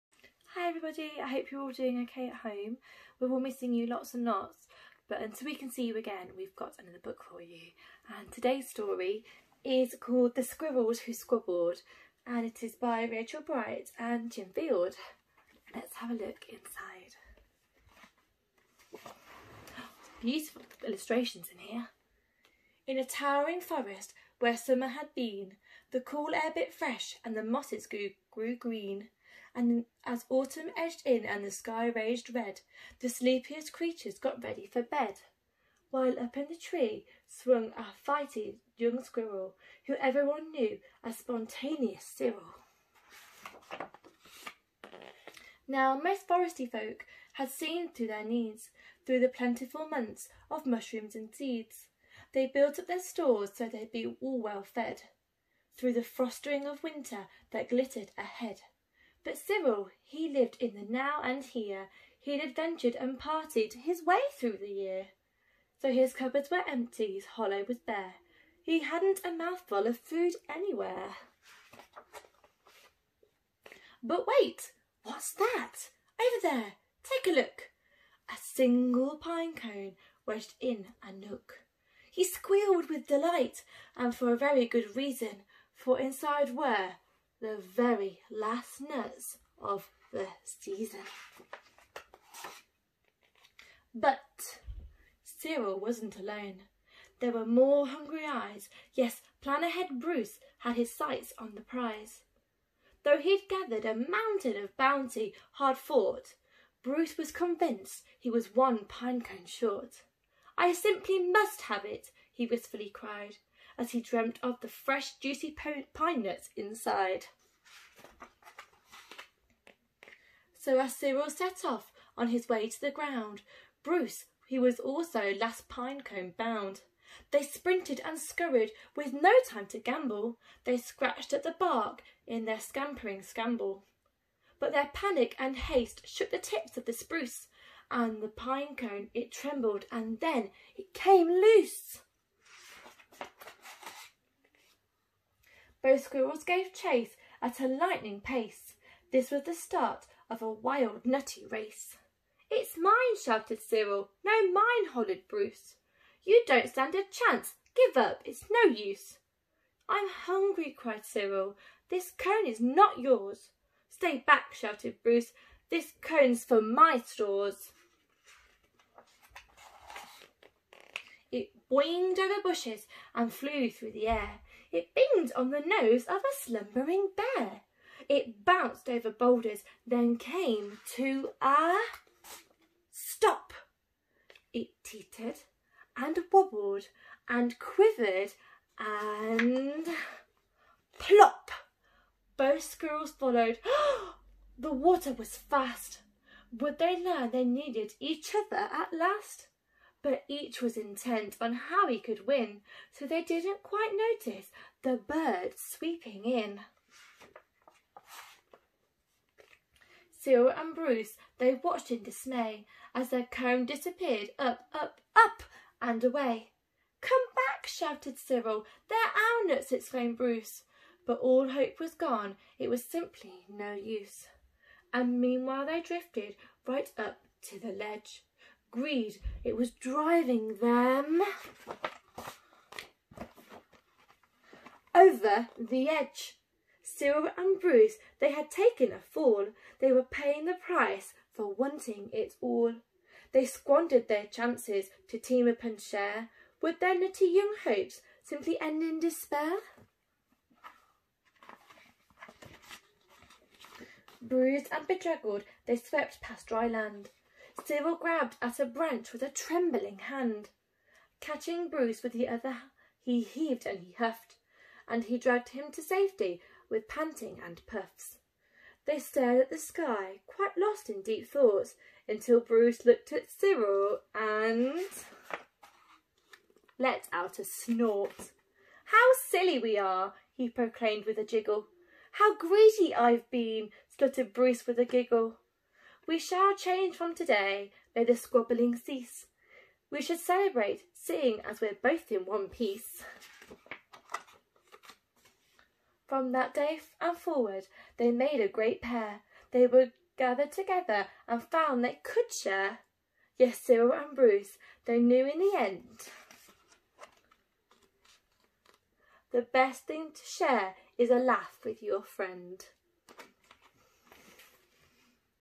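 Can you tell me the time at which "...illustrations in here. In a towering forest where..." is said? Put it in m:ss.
0:20.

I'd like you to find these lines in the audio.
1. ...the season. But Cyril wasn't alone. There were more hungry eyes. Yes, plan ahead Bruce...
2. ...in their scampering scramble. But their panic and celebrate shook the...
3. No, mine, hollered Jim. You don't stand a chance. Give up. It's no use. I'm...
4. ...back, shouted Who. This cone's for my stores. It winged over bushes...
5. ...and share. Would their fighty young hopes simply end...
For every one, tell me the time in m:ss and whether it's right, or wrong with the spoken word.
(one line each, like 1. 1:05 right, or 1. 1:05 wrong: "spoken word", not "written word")
1. 1:30 right
2. 2:12 wrong: "haste", not "celebrate"
3. 2:34 wrong: "Bruce", not "Jim"
4. 2:44 wrong: "Bruce", not "Who"
5. 4:05 wrong: "nutty", not "fighty".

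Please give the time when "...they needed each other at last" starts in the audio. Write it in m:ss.
3:17.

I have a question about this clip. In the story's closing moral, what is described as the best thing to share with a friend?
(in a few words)
a laugh.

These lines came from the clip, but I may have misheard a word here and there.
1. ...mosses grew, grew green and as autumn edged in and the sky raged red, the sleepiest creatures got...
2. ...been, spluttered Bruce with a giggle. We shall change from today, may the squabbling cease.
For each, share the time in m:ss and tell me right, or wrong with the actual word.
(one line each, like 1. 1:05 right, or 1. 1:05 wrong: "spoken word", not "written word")
1. 0:27 right
2. 4:43 right.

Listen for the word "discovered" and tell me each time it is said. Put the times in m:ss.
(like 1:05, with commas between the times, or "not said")
not said.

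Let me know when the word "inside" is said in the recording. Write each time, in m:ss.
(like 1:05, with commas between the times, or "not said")
0:16, 1:25, 1:56.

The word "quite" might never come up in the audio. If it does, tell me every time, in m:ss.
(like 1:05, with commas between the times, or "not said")
3:23, 4:30.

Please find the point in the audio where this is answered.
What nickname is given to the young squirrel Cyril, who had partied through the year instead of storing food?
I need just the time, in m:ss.
0:41.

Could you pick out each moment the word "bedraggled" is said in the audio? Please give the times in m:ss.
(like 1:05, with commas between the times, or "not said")
4:14.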